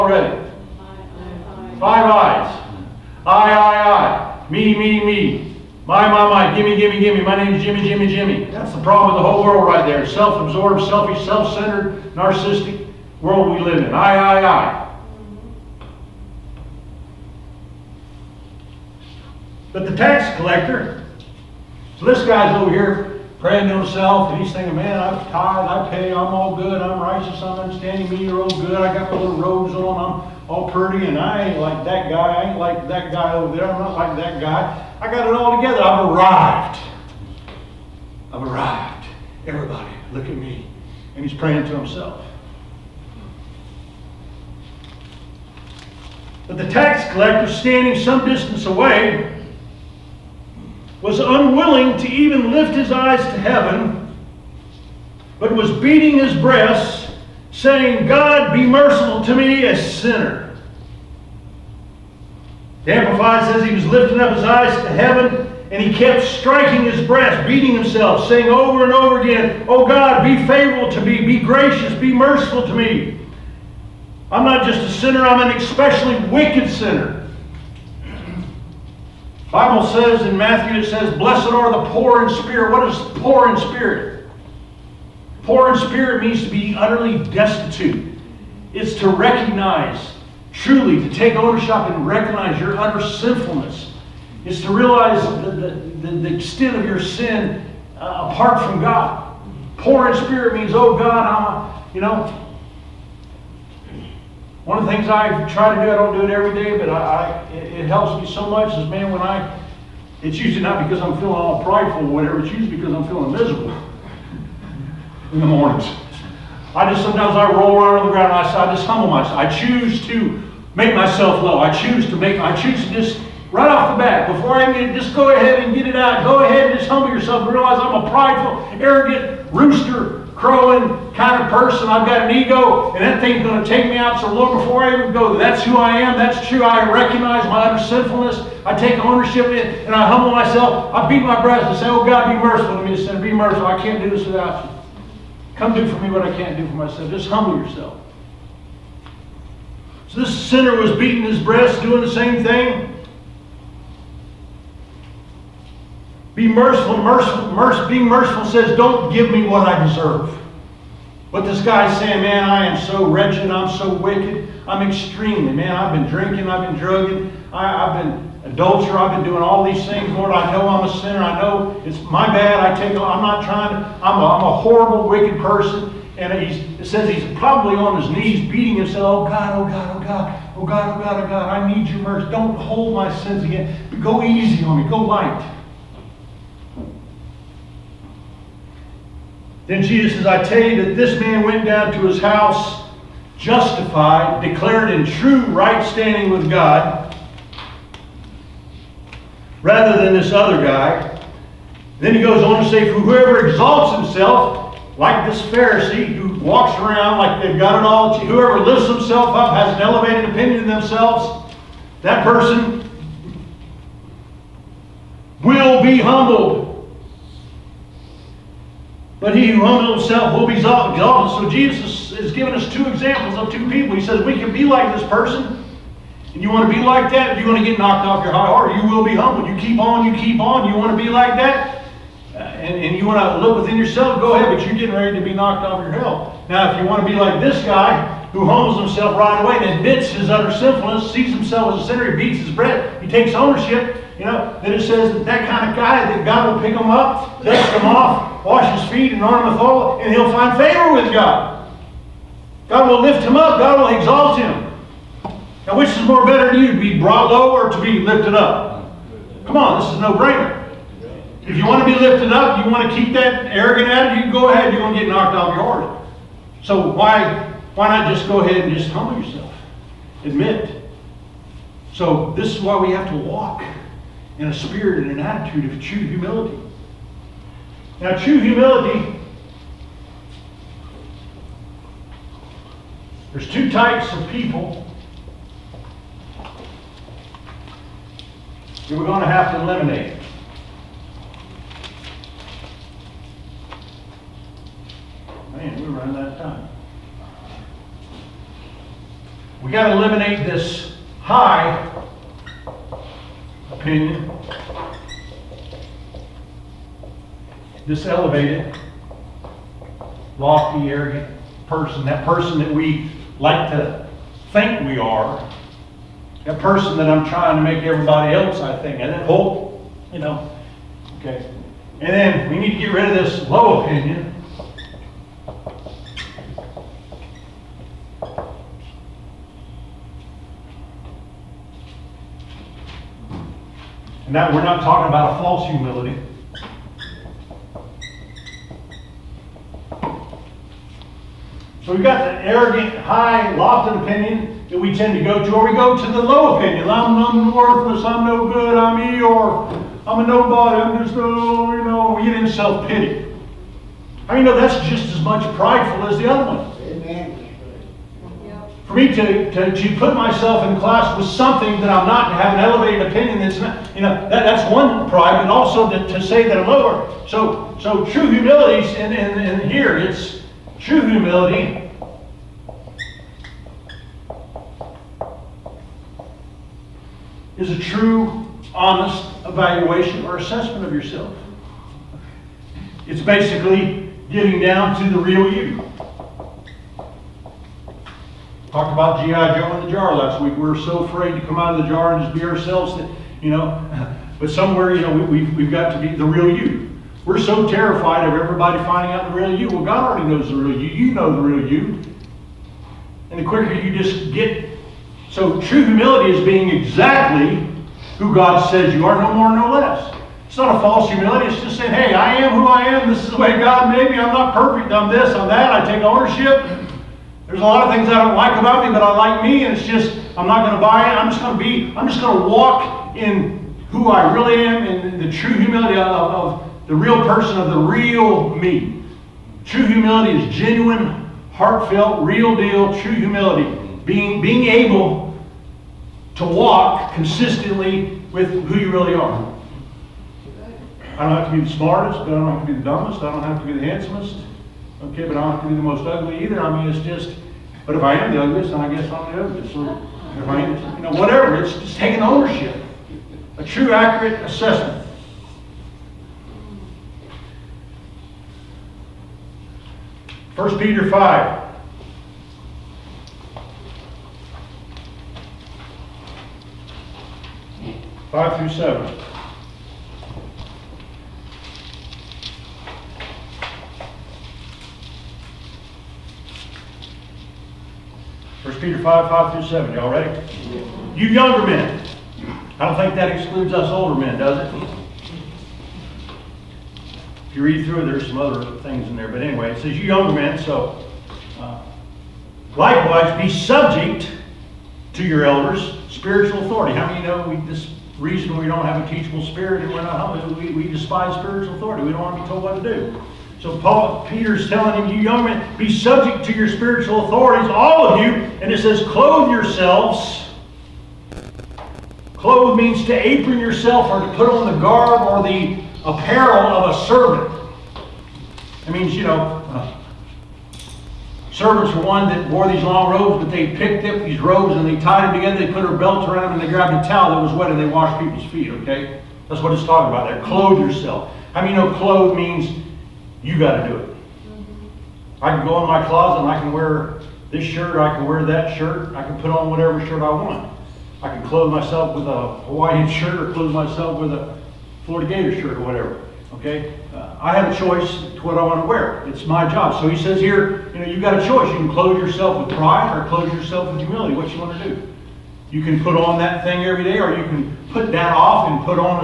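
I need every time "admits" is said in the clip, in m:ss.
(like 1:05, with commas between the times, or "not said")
3:59, 4:30.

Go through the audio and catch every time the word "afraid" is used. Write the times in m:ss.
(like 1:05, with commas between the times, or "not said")
6:31.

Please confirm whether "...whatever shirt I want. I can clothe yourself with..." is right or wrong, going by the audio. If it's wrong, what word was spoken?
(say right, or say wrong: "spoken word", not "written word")
wrong: "myself", not "yourself".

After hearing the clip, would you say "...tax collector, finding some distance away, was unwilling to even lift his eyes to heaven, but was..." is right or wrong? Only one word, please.
wrong.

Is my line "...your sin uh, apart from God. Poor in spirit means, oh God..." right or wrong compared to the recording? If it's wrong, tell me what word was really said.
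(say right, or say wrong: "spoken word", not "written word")
right.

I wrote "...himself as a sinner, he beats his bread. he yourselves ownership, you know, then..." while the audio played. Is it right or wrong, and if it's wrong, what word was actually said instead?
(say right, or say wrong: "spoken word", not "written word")
wrong: "takes", not "yourselves".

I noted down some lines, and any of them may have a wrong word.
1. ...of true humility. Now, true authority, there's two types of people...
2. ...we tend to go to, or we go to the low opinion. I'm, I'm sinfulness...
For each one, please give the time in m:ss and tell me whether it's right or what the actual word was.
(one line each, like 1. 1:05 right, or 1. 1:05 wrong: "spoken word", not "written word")
1. 4:35 wrong: "humility", not "authority"
2. 5:44 wrong: "worthless", not "sinfulness".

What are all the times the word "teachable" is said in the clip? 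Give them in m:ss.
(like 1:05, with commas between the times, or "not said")
8:19.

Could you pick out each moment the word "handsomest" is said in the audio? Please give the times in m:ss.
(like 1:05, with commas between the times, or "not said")
7:23.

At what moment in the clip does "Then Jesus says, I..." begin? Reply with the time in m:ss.
3:09.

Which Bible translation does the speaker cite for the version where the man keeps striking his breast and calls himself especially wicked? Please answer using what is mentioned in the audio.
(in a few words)
The Amplified.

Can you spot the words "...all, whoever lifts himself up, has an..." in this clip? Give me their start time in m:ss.
3:27.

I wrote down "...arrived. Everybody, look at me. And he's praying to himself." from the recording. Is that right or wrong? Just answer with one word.
right.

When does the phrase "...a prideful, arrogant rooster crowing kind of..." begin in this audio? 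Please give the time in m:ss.
2:08.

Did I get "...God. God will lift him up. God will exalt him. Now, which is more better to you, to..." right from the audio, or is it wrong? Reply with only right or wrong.
right.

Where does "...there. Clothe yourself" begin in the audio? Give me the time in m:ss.
8:50.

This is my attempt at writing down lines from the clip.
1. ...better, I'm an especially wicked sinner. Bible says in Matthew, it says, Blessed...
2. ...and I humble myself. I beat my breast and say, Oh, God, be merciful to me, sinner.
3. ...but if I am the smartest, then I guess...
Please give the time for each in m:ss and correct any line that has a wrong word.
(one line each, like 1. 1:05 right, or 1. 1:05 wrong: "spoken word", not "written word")
1. 1:14 wrong: "sinner", not "better"
2. 2:19 right
3. 7:27 wrong: "ugliest", not "smartest".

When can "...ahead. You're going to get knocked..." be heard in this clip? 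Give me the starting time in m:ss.
4:24.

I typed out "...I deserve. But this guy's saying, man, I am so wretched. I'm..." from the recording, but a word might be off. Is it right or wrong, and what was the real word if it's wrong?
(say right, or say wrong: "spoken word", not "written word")
right.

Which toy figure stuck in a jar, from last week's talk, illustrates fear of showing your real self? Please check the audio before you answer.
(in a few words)
G.I. Joe.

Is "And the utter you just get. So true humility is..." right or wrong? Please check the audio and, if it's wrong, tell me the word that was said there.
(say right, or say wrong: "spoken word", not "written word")
wrong: "quicker", not "utter".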